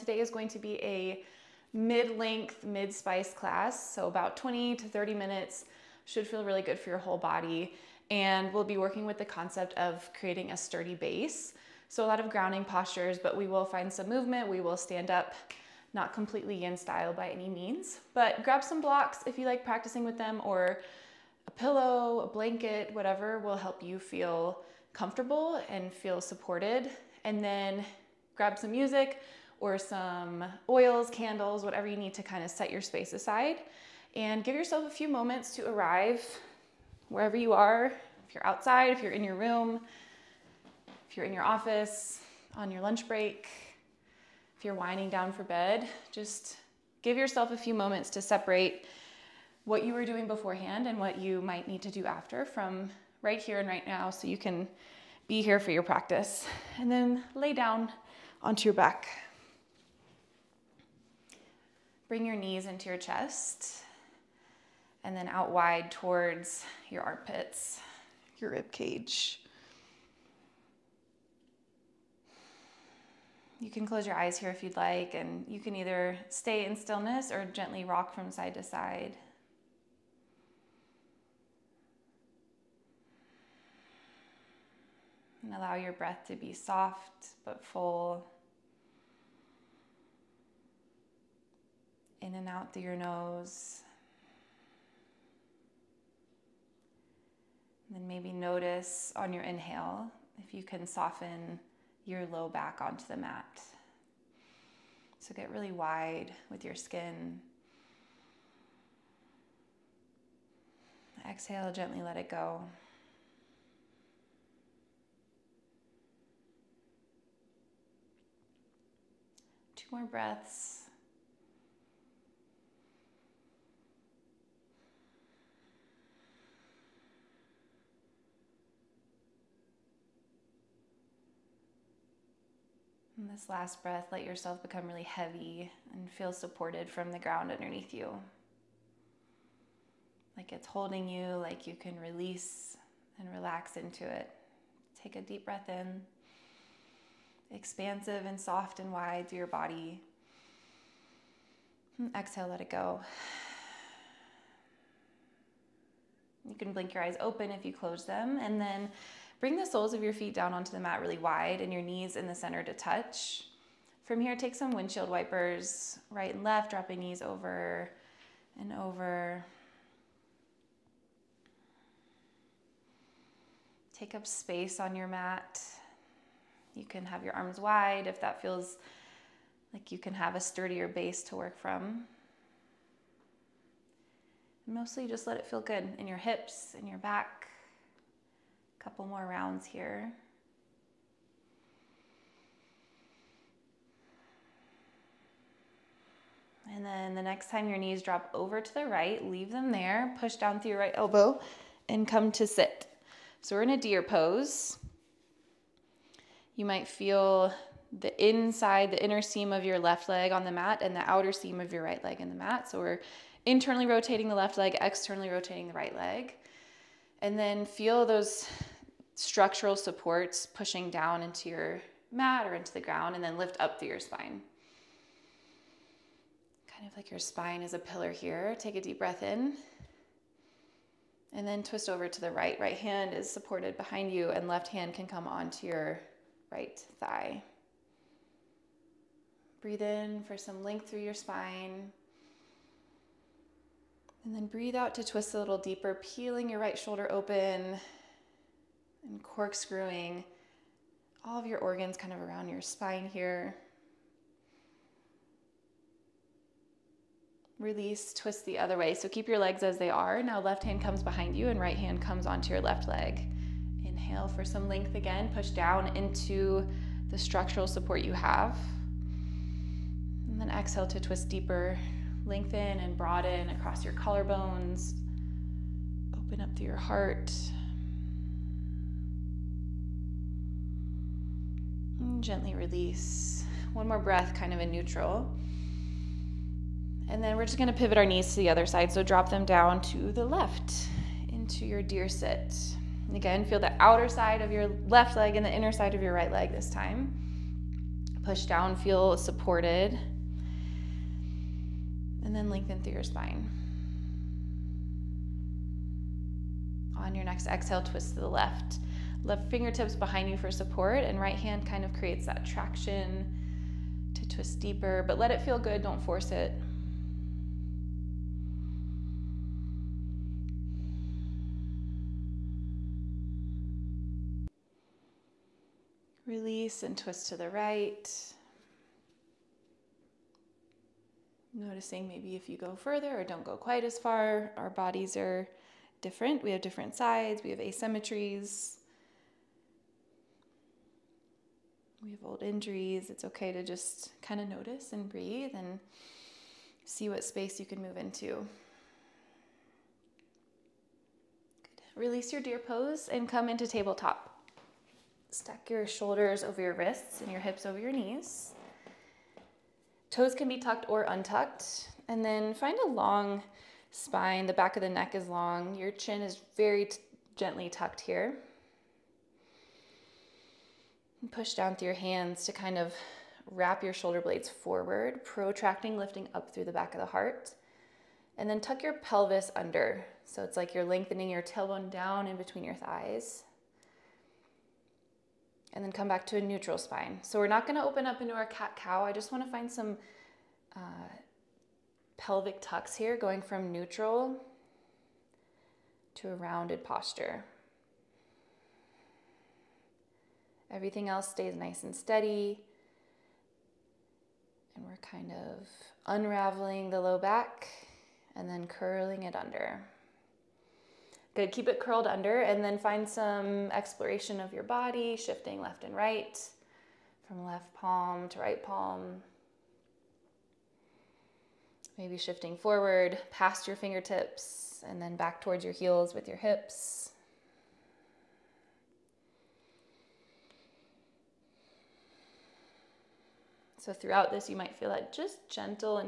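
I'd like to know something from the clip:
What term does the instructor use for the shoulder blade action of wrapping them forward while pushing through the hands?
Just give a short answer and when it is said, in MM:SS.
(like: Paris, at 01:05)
protracting, at 06:15.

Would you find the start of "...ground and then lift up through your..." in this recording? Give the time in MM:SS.
03:42.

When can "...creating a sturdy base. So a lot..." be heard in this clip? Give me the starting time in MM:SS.
00:10.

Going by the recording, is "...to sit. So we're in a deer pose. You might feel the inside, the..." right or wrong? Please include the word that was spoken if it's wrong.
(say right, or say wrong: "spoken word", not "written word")
right.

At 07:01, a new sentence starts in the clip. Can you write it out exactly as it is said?
Maybe shifting forward past your fingertips and then back towards your heels with your hips.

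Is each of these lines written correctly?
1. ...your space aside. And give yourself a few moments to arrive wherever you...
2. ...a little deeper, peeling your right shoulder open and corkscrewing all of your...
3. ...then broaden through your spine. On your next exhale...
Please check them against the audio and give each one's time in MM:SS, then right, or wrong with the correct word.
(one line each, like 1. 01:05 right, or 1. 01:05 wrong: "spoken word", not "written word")
1. 00:32 right
2. 04:05 right
3. 05:02 wrong: "lengthen", not "broaden".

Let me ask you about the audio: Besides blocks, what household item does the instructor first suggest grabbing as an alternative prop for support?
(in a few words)
a pillow.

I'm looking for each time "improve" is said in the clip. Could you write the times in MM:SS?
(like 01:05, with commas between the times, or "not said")
not said.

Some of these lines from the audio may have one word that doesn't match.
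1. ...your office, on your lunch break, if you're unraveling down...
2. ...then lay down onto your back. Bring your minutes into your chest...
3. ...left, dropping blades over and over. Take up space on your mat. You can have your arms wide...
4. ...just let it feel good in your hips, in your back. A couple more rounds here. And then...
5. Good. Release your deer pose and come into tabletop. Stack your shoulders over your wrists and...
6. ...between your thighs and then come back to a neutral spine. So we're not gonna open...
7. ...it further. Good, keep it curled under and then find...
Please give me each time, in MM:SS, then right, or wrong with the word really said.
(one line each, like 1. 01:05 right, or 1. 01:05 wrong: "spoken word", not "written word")
1. 00:41 wrong: "winding", not "unraveling"
2. 00:56 wrong: "knees", not "minutes"
3. 02:46 wrong: "knees", not "blades"
4. 03:05 right
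5. 05:48 right
6. 06:22 right
7. 06:49 wrong: "under", not "further".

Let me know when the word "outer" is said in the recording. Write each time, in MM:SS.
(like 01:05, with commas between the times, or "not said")
03:31, 04:53.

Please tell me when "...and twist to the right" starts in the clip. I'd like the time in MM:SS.
05:26.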